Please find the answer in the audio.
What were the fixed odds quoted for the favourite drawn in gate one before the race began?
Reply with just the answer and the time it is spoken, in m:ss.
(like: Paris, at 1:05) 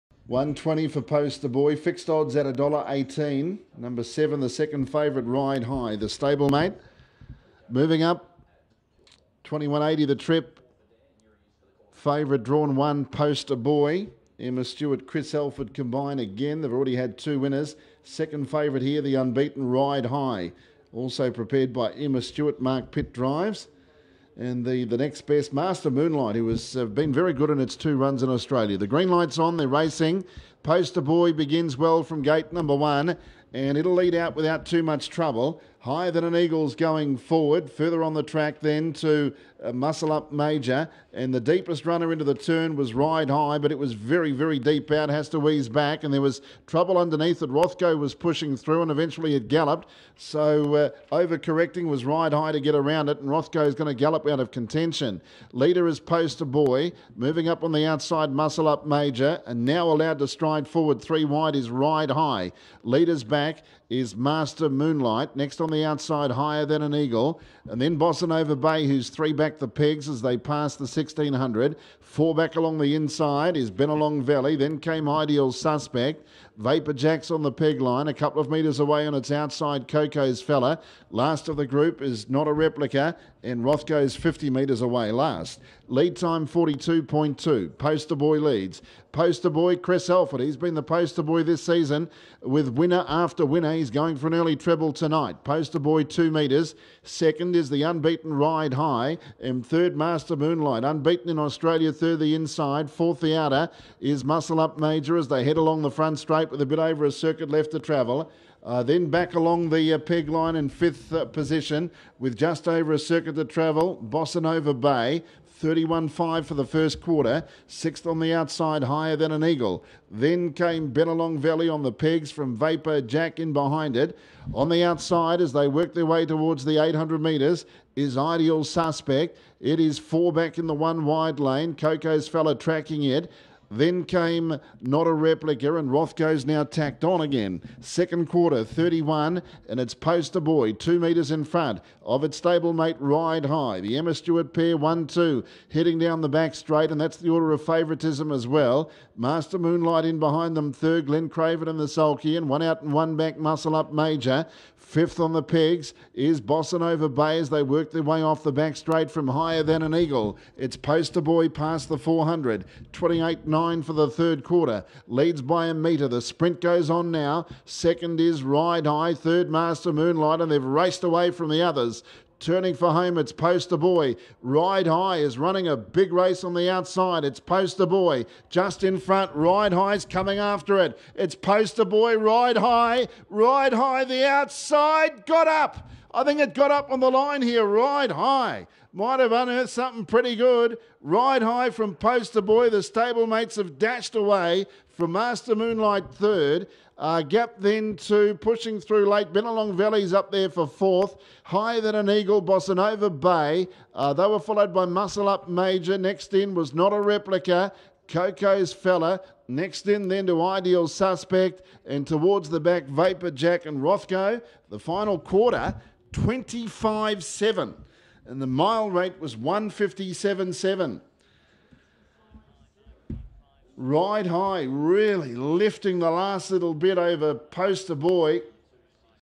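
$1.18, at 0:02.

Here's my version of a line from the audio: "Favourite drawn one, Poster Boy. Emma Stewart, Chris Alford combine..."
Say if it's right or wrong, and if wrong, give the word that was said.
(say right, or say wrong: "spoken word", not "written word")
right.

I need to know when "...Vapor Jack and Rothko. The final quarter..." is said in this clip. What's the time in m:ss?
3:32.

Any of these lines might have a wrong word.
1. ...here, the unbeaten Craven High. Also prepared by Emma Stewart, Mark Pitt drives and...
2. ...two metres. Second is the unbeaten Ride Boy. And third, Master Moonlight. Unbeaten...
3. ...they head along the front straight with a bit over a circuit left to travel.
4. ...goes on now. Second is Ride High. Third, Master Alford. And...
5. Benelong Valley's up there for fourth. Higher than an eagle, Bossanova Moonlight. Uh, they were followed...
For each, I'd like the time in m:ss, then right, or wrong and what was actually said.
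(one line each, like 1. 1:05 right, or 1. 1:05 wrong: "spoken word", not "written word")
1. 0:18 wrong: "Ride", not "Craven"
2. 1:36 wrong: "High", not "Boy"
3. 1:45 right
4. 2:46 wrong: "Moonlight", not "Alford"
5. 3:19 wrong: "Bay", not "Moonlight".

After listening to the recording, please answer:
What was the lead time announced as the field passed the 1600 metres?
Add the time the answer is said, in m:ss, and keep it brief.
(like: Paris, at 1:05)
42.2, at 1:26.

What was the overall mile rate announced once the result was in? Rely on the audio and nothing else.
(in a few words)
1:57.7.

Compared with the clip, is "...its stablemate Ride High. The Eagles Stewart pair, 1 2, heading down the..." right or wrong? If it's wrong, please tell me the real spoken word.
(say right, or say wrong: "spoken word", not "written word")
wrong: "Emma", not "Eagles".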